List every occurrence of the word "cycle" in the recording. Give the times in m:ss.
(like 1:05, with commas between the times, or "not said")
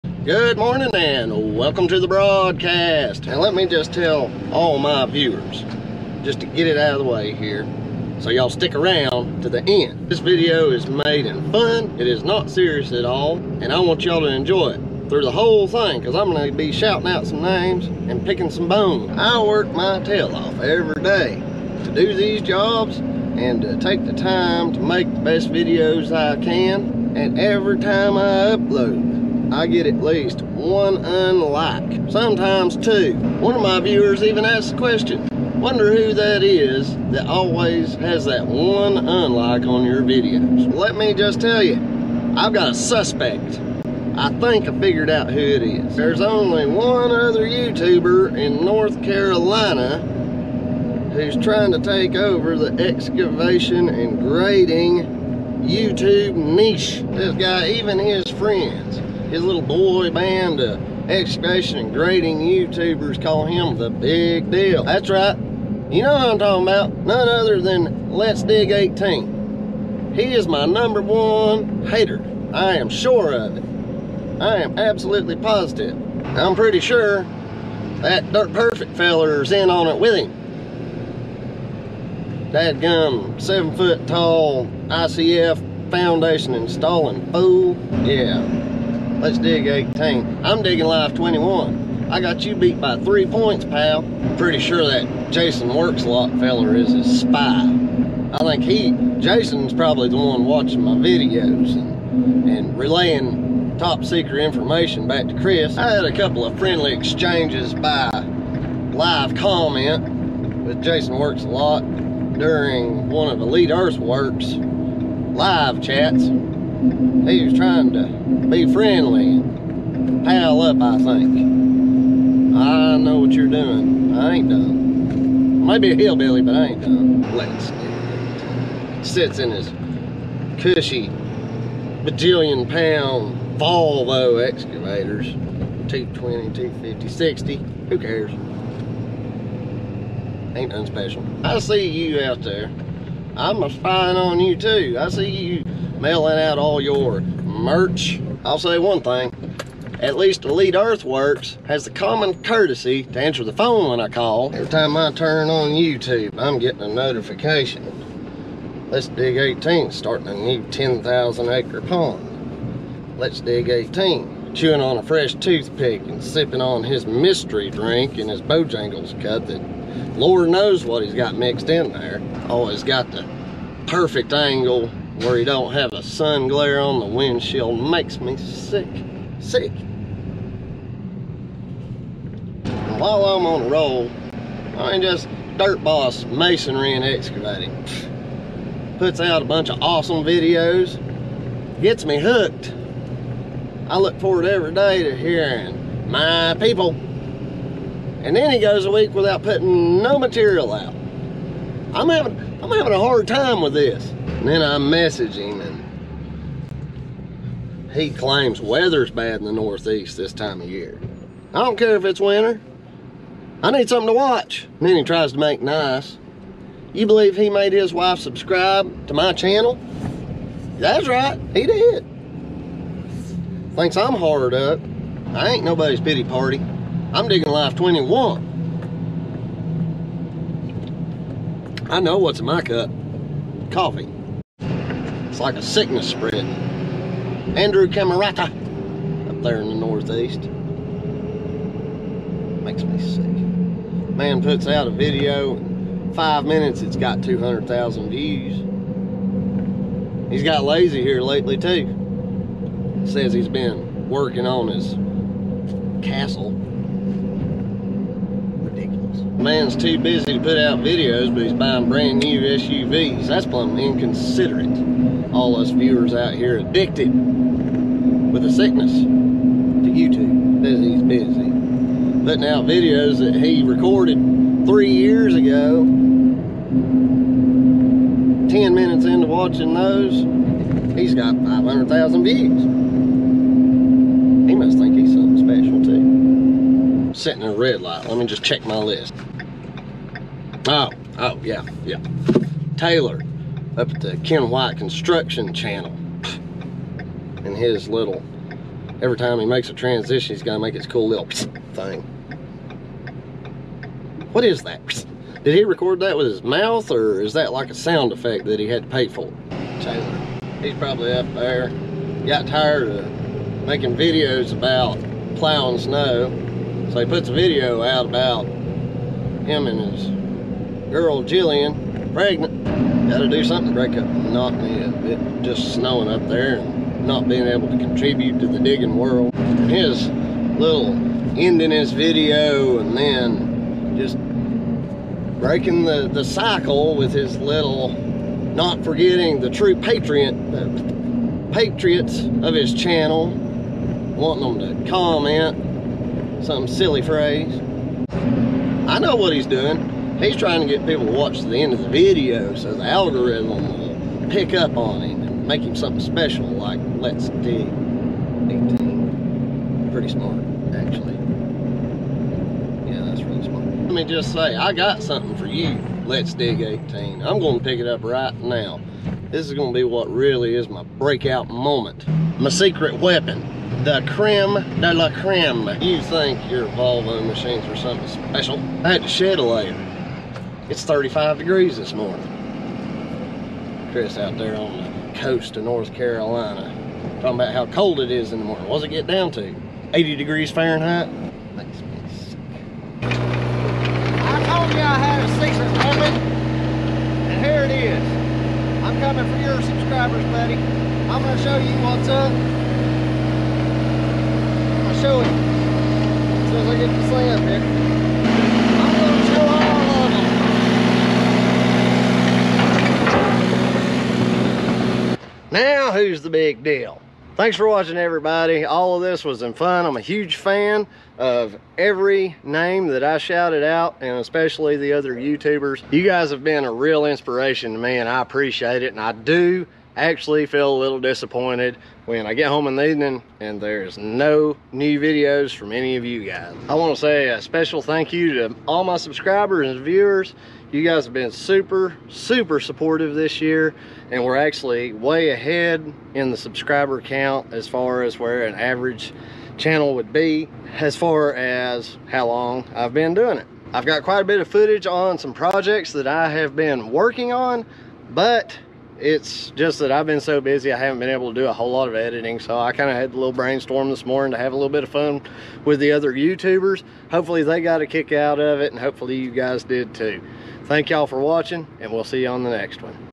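5:36.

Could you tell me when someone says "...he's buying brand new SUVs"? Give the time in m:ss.
4:21.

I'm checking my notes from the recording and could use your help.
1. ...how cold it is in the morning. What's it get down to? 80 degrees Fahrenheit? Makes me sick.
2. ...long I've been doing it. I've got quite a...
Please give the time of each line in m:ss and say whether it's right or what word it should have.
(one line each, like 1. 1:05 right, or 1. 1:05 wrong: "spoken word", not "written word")
1. 6:27 right
2. 7:32 right.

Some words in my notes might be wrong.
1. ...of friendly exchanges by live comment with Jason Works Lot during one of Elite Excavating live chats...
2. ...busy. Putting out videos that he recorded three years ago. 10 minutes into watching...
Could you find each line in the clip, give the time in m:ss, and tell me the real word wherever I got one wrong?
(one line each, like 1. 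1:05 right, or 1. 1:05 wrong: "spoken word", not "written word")
1. 1:46 wrong: "Earthworks", not "Excavating"
2. 4:31 right.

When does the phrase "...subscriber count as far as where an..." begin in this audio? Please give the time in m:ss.
7:26.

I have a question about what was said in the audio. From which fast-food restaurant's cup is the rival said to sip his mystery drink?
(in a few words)
Bojangles.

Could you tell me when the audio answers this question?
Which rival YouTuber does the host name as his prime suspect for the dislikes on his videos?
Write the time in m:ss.
1:07.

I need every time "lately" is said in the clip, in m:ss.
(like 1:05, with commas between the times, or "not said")
4:11.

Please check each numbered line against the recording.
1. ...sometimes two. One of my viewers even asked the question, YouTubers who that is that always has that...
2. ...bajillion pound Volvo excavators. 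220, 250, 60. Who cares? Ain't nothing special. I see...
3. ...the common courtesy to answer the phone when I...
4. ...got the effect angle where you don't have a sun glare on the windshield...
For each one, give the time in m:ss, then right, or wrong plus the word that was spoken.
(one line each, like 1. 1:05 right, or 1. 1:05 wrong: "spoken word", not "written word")
1. 0:32 wrong: "Wonder", not "YouTubers"
2. 2:12 right
3. 2:31 right
4. 2:52 wrong: "perfect", not "effect".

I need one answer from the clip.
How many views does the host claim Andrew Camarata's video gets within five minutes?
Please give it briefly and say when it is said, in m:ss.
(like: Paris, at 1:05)
200,000, at 4:07.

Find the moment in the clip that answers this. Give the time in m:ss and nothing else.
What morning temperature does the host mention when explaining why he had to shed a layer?
6:20.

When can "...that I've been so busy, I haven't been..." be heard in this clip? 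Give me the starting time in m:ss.
7:39.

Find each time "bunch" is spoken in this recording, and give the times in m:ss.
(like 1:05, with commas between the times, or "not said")
3:09.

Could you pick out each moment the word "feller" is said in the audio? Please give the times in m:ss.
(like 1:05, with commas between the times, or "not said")
1:18, 1:36.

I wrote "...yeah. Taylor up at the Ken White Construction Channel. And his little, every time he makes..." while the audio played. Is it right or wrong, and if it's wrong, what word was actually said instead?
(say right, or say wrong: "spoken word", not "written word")
right.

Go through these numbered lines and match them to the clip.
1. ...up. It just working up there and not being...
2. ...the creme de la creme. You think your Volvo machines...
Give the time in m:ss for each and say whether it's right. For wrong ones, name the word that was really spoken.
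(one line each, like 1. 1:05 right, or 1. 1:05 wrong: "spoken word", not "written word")
1. 5:24 wrong: "snowing", not "working"
2. 6:13 right.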